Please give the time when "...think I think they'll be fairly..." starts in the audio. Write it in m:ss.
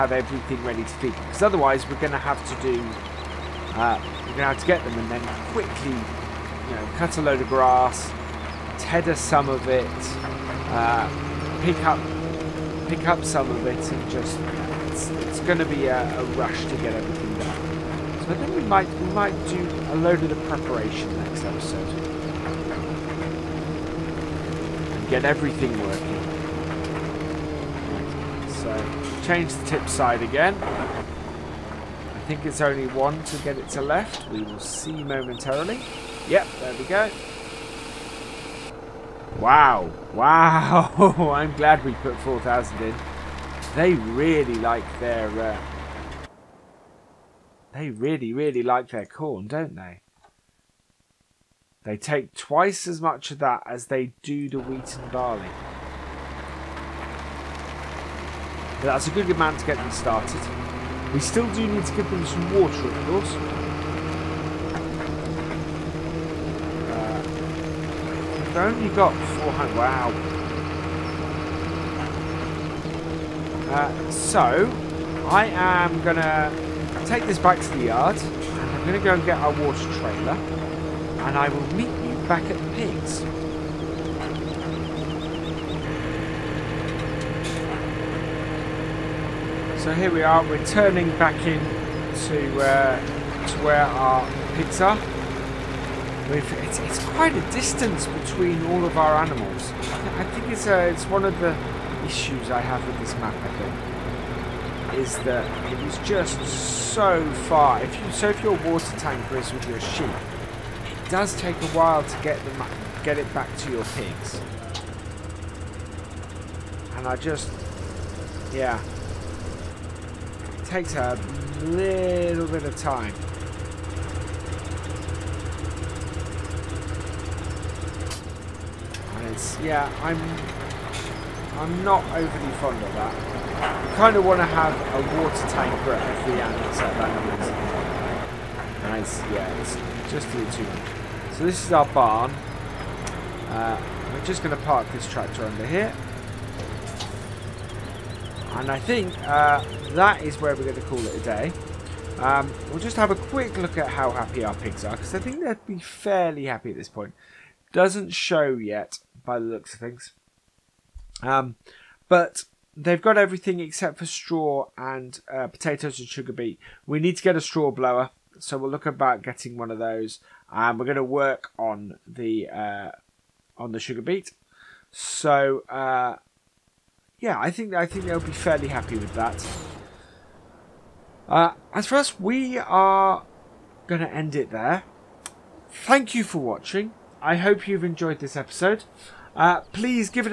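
2:57.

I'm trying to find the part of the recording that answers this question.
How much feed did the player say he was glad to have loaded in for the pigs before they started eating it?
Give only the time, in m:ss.
0:42.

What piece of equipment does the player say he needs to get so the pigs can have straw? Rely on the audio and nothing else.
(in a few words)
Straw blower.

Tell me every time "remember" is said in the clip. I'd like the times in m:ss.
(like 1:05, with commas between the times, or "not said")
not said.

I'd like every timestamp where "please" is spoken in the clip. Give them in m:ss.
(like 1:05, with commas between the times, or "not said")
3:09.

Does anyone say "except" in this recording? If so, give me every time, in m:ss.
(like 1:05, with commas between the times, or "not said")
2:16, 2:43.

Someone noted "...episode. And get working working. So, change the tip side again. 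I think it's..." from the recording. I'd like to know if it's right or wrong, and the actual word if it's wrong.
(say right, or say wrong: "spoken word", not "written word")
wrong: "everything", not "working".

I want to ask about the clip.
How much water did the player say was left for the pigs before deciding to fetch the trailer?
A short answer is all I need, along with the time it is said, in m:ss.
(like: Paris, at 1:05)
400, at 1:09.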